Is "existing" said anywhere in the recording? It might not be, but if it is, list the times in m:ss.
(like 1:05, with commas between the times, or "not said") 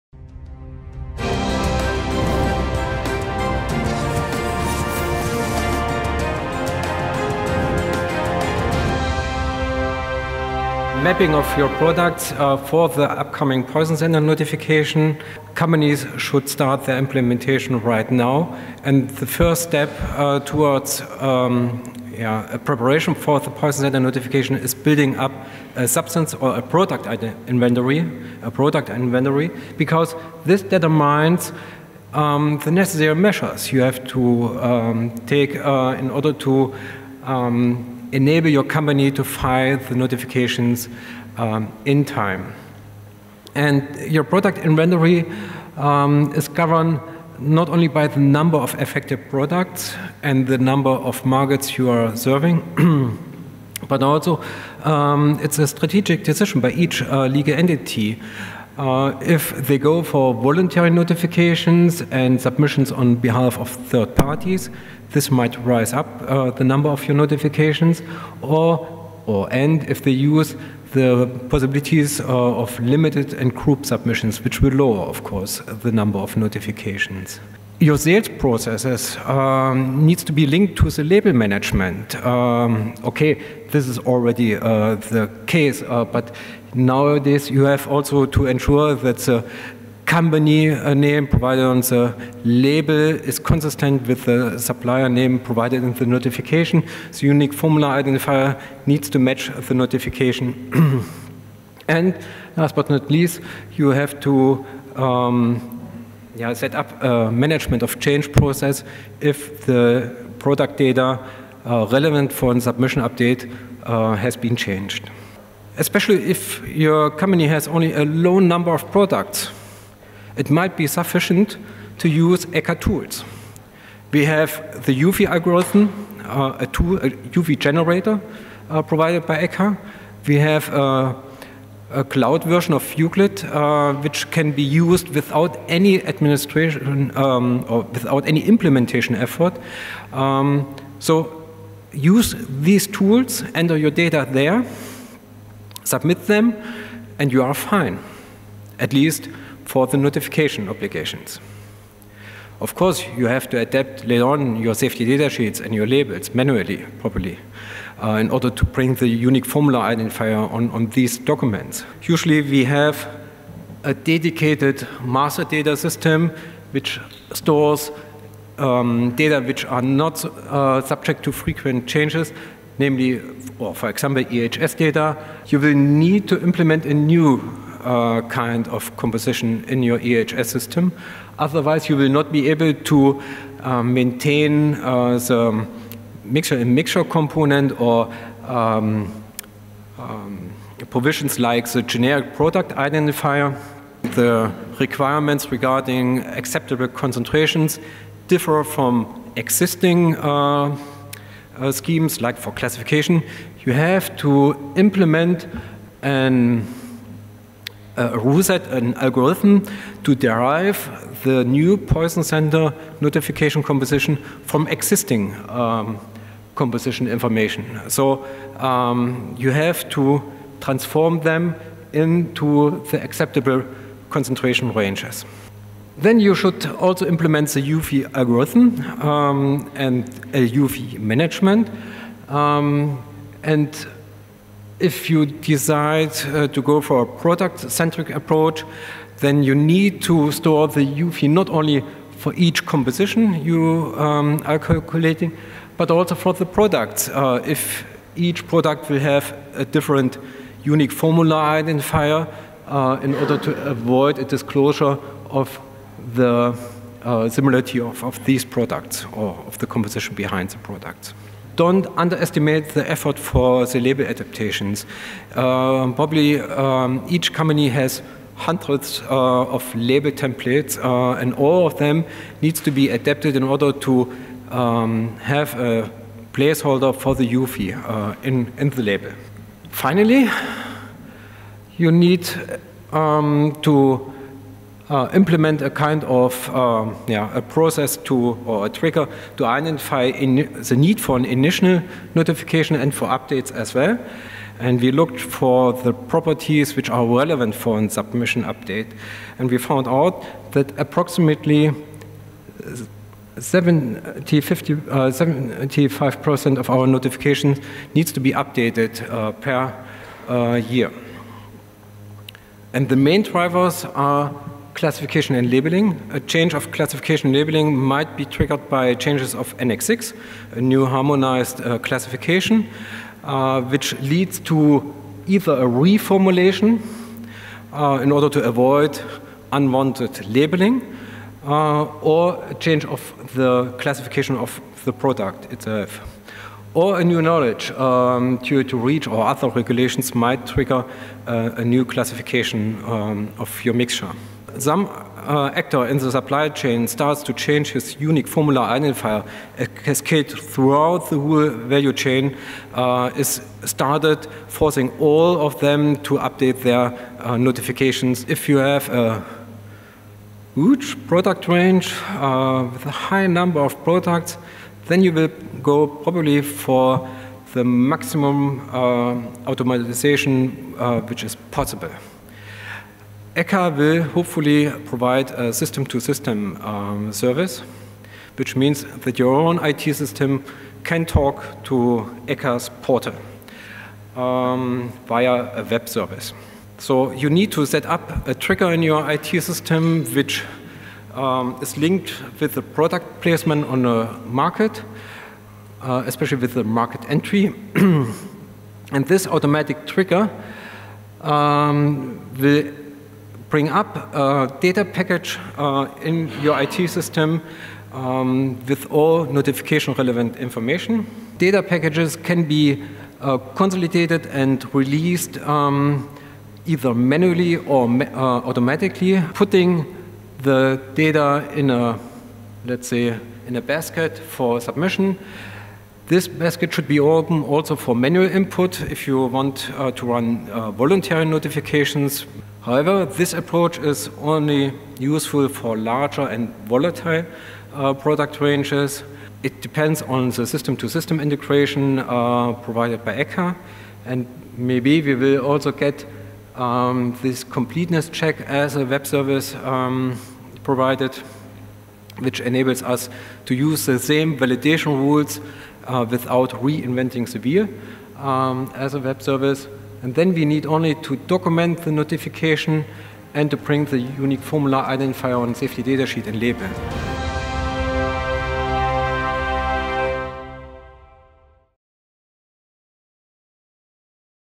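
3:19, 3:34.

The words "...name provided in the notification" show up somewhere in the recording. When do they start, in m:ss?
1:35.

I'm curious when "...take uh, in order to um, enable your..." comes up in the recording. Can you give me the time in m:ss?
0:35.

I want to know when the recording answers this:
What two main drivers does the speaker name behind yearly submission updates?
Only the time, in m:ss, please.
5:14.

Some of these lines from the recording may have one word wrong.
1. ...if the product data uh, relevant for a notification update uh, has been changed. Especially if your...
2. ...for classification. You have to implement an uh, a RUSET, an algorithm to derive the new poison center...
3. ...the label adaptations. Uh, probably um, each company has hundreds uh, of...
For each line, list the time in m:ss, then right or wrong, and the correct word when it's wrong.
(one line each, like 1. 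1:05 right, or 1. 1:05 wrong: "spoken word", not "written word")
1. 1:49 wrong: "submission", not "notification"
2. 3:22 right
3. 4:23 right.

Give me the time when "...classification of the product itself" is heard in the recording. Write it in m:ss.
5:33.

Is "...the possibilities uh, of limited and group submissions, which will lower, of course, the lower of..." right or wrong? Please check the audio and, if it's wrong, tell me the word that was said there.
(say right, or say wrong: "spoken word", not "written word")
wrong: "number", not "lower".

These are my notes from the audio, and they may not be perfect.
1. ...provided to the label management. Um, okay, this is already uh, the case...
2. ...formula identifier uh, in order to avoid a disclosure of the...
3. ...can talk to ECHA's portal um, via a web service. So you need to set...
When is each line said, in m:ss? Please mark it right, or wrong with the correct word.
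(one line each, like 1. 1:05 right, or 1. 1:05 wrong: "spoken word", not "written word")
1. 1:20 wrong: "linked", not "provided"
2. 4:10 right
3. 6:20 right.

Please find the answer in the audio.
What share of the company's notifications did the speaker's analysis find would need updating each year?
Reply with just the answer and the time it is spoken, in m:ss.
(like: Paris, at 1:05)
75%, at 5:03.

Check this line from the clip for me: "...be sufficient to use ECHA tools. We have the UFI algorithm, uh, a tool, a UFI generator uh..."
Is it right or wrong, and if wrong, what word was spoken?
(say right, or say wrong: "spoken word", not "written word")
right.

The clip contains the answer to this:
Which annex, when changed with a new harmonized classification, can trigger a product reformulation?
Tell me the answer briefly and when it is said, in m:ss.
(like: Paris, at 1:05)
Annex 6, at 5:19.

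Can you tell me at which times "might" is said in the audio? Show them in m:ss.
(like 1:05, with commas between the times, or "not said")
1:05, 2:00, 5:17, 5:40.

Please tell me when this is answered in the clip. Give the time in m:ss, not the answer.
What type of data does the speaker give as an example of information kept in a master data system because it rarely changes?
2:54.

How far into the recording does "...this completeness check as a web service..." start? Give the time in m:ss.
7:27.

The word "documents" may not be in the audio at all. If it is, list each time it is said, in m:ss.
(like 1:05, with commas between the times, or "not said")
2:41, 7:41.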